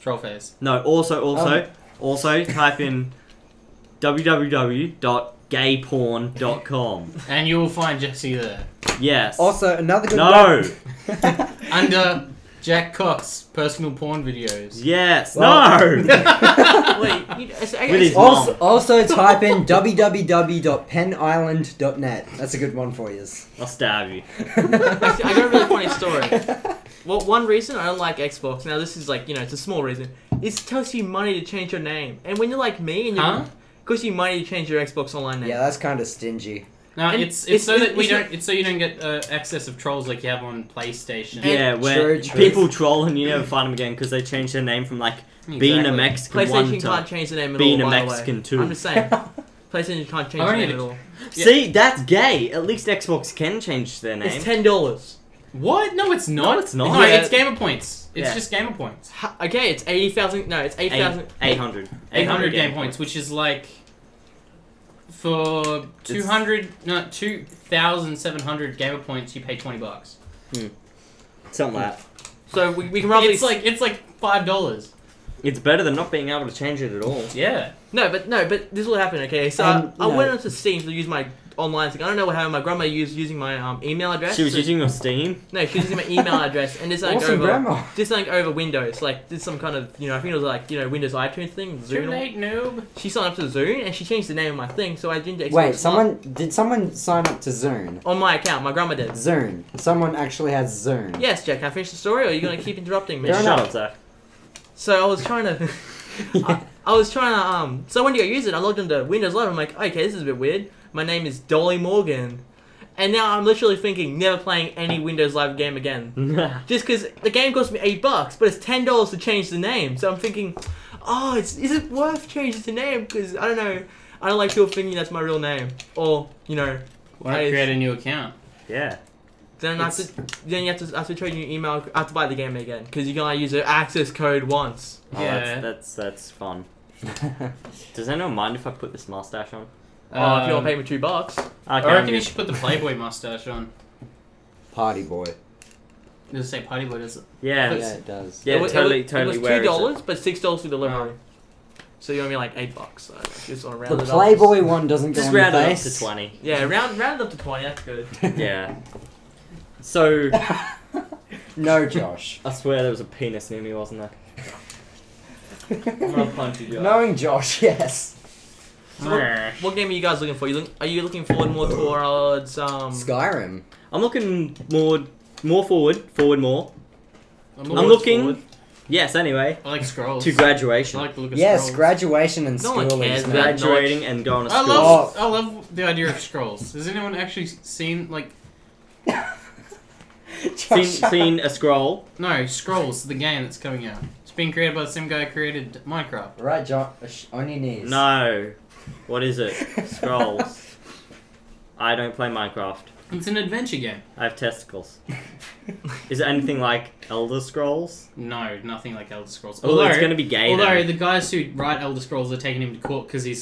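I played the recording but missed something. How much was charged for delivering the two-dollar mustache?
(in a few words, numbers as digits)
6 dollars.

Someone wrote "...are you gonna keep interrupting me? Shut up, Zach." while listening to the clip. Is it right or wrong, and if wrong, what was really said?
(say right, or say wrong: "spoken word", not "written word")
right.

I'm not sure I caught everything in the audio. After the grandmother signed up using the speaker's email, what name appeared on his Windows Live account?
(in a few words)
Dolly Morgan.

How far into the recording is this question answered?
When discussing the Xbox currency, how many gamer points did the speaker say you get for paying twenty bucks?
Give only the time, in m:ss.
1:07.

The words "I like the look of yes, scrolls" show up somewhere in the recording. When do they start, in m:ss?
3:00.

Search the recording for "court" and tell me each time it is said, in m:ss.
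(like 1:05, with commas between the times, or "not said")
3:32.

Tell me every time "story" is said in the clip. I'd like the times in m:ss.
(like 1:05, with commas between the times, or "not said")
0:25, 1:41.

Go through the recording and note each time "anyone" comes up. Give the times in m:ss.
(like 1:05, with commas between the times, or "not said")
2:18, 3:06.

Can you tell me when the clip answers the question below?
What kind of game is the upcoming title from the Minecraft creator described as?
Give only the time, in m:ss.
3:23.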